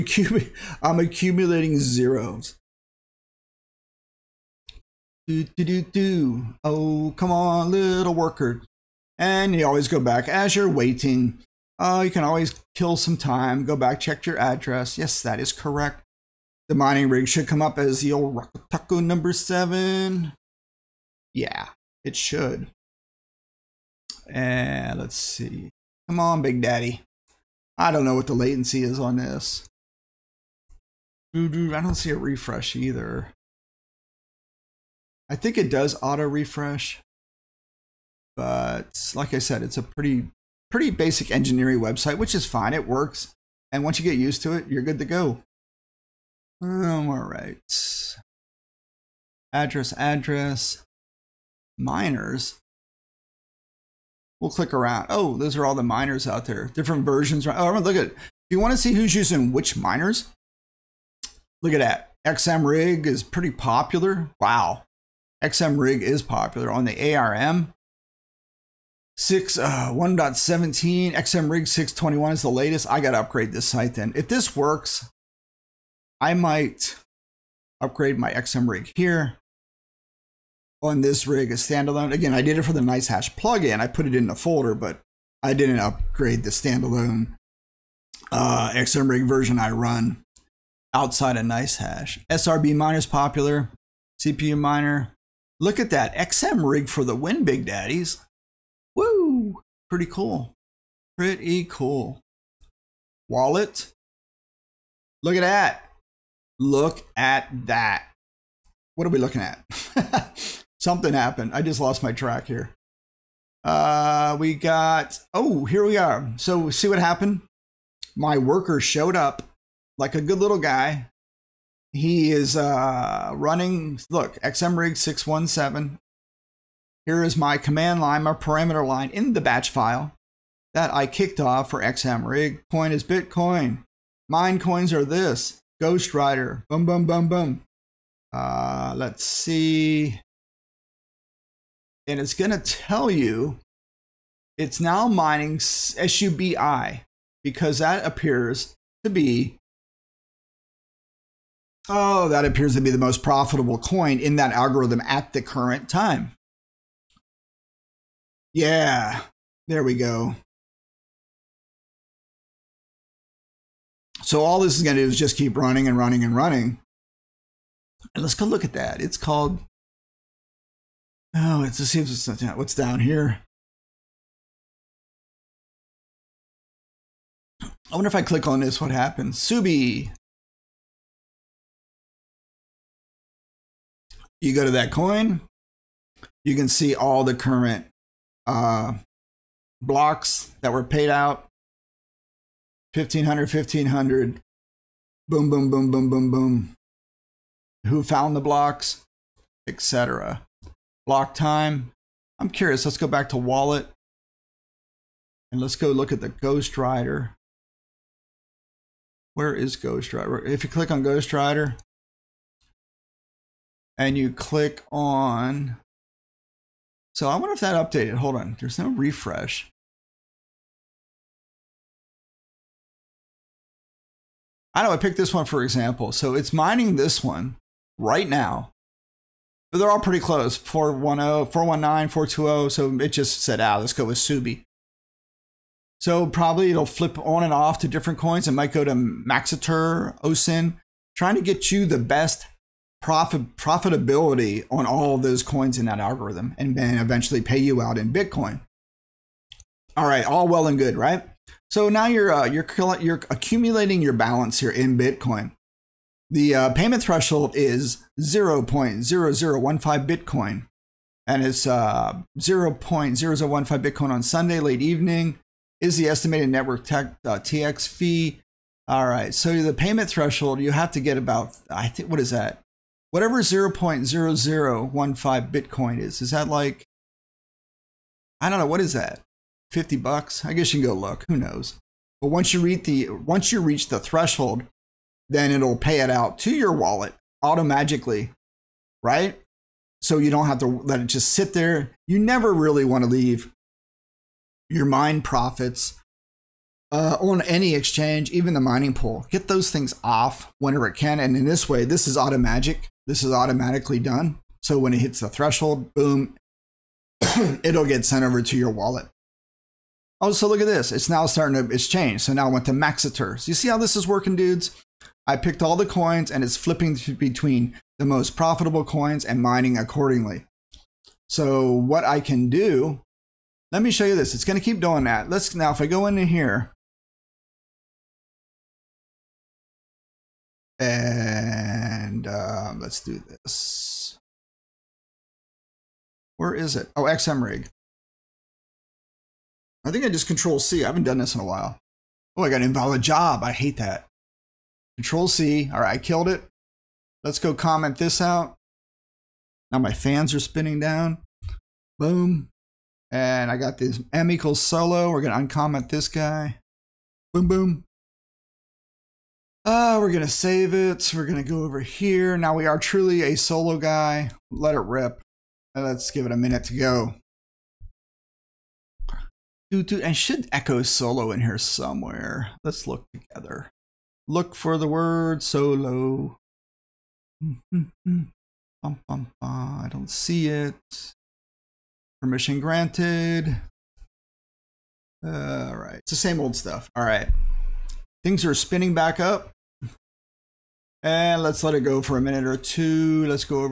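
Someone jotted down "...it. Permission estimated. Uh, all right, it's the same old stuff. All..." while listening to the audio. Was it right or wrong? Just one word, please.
wrong.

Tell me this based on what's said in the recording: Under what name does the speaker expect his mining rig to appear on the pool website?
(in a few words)
Rocco Taco number 7.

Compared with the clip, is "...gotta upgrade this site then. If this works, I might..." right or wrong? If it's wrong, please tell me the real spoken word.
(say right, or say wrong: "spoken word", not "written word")
right.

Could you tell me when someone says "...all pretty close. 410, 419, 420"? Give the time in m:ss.
3:49.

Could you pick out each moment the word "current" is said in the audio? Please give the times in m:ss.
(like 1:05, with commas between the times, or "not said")
2:35, 3:07.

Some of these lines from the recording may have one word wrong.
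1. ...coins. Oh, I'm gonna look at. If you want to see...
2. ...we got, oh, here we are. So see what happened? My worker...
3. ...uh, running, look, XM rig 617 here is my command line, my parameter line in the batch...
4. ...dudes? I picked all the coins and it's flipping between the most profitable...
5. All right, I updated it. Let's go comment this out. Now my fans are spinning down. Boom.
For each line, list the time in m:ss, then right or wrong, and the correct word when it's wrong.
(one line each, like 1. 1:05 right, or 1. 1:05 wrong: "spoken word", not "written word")
1. 0:57 wrong: "versions", not "coins"
2. 1:54 right
3. 2:02 right
4. 5:14 right
5. 5:45 wrong: "killed", not "updated".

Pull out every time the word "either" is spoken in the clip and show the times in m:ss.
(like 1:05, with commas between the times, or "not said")
0:32.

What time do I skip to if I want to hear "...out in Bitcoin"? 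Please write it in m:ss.
4:07.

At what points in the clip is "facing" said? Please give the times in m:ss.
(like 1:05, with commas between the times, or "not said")
not said.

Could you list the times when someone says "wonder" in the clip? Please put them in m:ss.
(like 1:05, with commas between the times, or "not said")
2:57, 3:37.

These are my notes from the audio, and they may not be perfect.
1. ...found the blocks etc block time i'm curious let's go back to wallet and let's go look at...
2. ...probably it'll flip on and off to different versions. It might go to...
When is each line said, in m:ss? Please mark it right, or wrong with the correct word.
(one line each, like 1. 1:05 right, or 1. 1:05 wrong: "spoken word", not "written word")
1. 3:18 right
2. 3:56 wrong: "coins", not "versions".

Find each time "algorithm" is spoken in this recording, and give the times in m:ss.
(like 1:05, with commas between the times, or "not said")
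2:34, 4:05.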